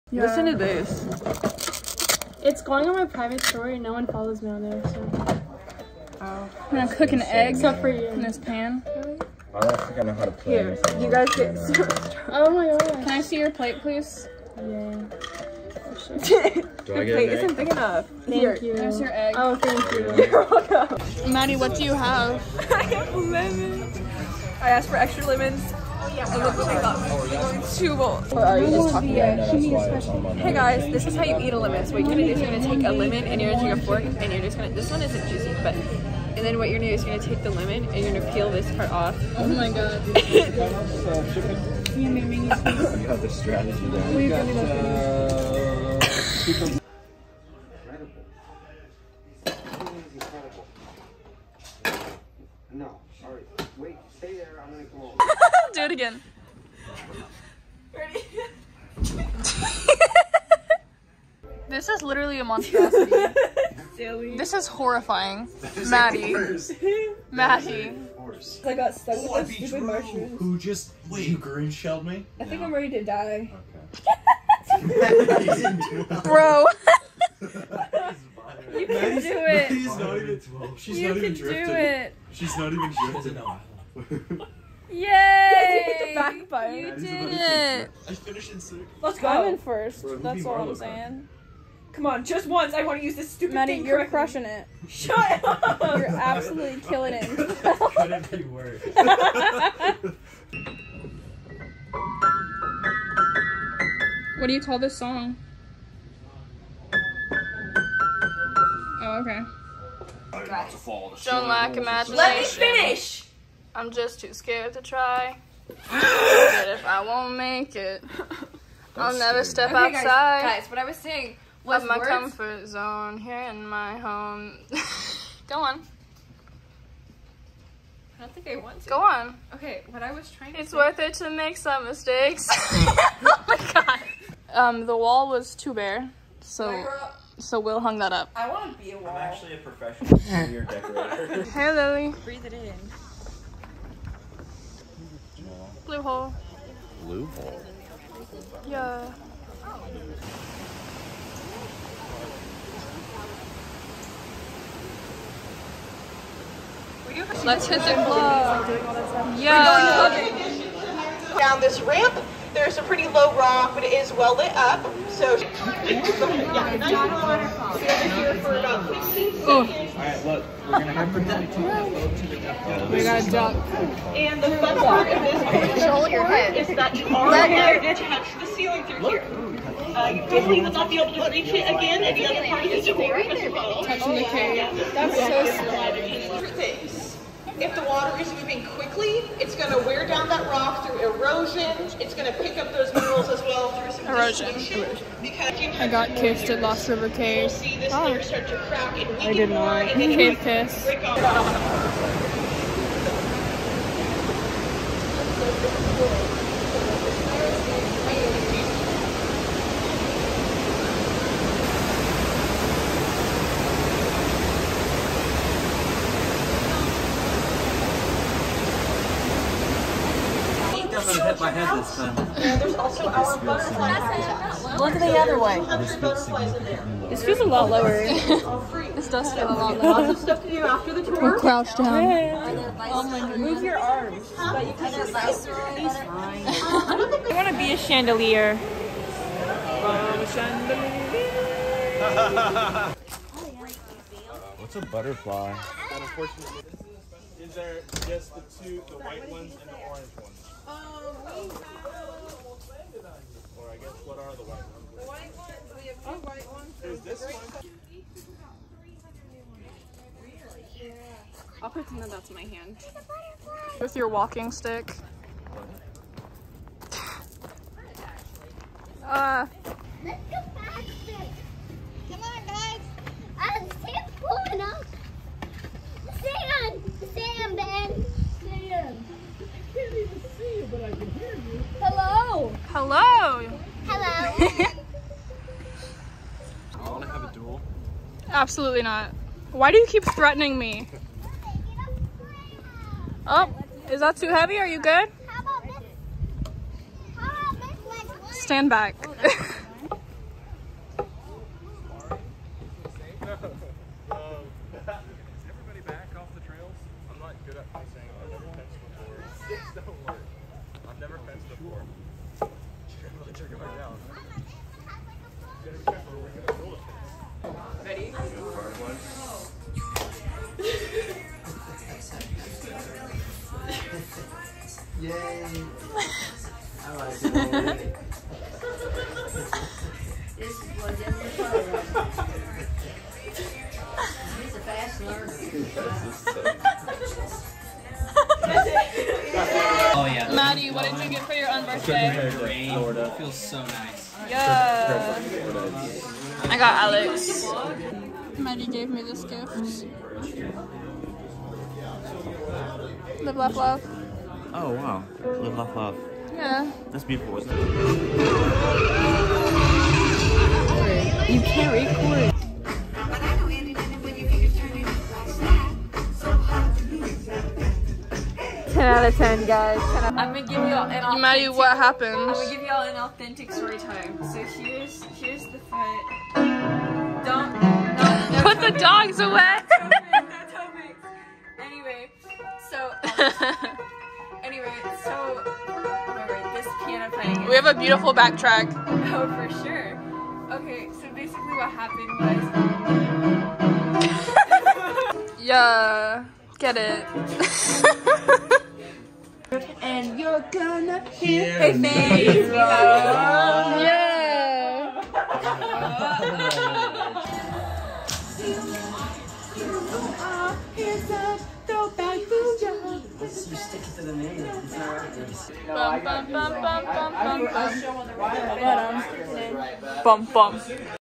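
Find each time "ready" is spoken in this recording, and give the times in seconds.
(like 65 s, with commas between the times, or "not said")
57 s, 72 s.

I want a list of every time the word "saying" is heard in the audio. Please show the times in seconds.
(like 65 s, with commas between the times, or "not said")
90 s, 120 s.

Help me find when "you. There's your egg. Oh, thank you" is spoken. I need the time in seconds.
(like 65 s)
18 s.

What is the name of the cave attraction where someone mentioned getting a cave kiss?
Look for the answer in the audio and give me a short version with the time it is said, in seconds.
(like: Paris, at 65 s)
Lost River Caves, at 196 s.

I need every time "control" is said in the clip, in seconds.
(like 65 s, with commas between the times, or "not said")
175 s.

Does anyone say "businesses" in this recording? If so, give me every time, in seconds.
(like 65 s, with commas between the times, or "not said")
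not said.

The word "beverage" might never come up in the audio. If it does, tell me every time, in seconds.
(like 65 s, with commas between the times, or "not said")
not said.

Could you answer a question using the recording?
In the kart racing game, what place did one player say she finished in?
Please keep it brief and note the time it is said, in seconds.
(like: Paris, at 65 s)
6th, at 88 s.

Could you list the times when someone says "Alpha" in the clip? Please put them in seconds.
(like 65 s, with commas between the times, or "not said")
not said.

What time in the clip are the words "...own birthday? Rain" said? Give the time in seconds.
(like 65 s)
341 s.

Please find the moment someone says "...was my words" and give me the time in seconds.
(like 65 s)
121 s.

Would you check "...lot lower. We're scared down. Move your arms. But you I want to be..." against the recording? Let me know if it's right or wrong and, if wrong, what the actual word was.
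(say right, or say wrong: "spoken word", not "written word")
wrong: "crouched", not "scared".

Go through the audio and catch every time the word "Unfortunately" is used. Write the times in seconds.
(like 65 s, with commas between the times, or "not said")
245 s.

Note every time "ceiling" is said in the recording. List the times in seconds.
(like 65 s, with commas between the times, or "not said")
178 s, 184 s.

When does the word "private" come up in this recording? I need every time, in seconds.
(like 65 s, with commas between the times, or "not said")
3 s.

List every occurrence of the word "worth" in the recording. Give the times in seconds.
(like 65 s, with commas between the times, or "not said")
130 s.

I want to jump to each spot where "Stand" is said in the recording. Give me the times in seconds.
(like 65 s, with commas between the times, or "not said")
298 s.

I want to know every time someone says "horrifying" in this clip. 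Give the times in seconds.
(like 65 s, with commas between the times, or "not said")
64 s.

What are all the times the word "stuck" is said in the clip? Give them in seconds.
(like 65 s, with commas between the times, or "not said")
68 s.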